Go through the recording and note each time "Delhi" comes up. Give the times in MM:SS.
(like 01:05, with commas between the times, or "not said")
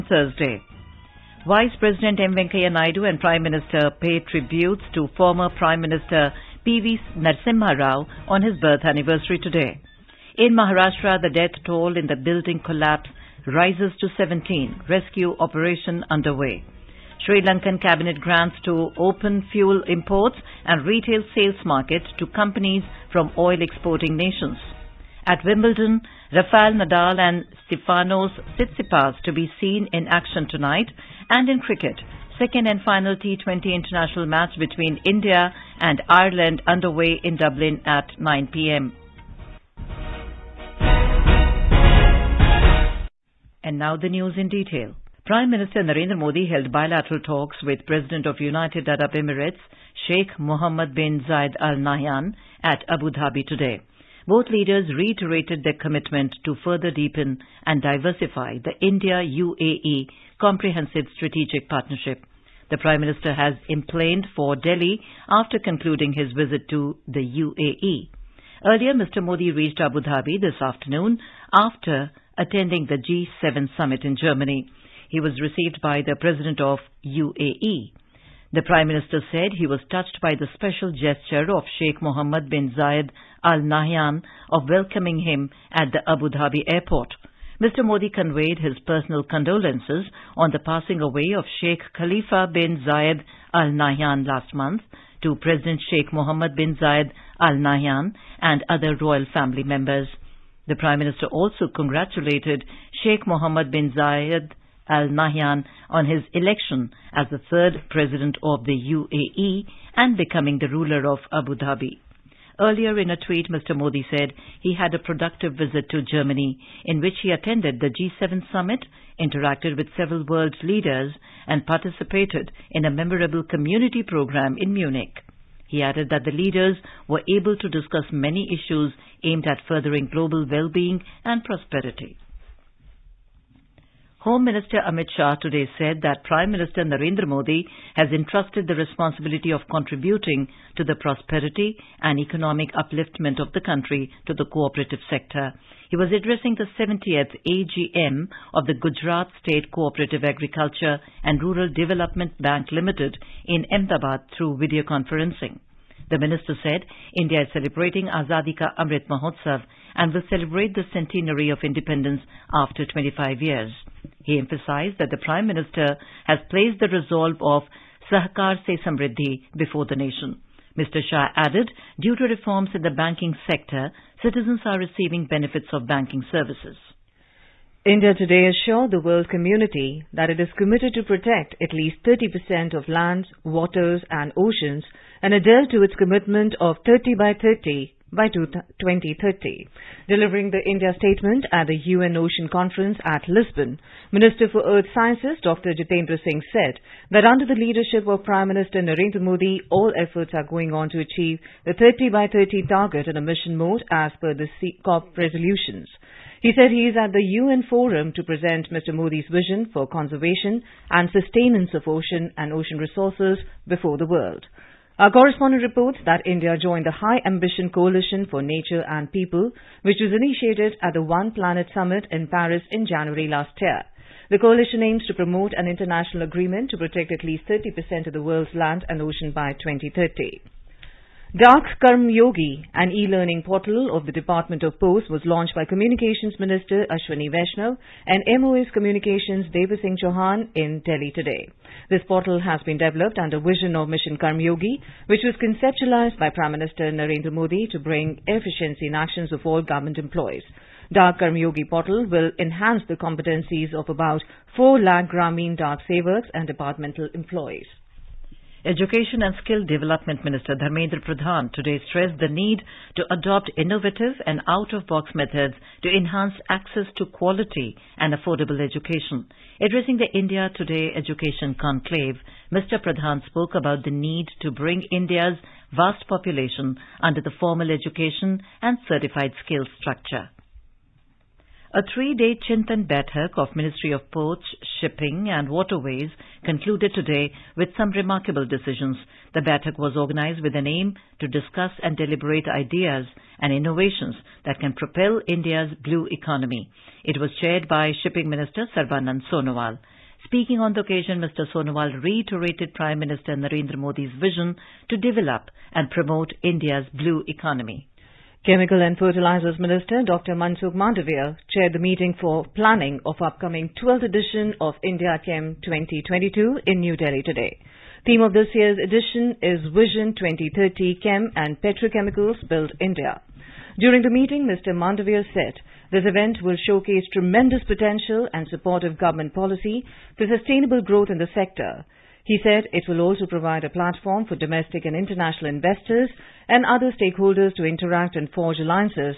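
01:04, 04:00, 05:16.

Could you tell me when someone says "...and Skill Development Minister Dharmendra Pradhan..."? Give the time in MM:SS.
04:19.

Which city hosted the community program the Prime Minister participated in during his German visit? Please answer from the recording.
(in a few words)
Munich.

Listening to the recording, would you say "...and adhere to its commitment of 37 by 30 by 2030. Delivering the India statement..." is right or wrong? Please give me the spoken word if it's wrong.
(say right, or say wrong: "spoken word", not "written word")
wrong: "30", not "37".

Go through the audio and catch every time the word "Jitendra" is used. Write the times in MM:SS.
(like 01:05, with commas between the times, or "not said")
03:15.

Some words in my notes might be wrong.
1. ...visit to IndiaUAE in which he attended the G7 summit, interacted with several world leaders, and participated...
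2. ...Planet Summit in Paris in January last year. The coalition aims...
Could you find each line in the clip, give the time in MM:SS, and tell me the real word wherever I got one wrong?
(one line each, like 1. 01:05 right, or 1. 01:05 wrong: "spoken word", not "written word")
1. 01:55 wrong: "Germany", not "IndiaUAE"
2. 03:41 right.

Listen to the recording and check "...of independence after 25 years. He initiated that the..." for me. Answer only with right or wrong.
wrong.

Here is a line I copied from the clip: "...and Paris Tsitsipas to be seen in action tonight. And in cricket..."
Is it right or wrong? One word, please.
wrong.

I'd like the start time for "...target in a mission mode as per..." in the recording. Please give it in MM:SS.
03:22.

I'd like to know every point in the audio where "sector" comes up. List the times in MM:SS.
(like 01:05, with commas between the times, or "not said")
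02:25, 02:53, 05:31.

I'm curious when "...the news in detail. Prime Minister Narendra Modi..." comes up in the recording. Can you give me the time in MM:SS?
00:43.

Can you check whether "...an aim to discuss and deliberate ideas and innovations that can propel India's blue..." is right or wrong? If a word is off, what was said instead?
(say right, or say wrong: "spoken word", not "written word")
right.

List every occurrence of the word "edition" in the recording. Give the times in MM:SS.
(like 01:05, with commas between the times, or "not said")
05:14, 05:18.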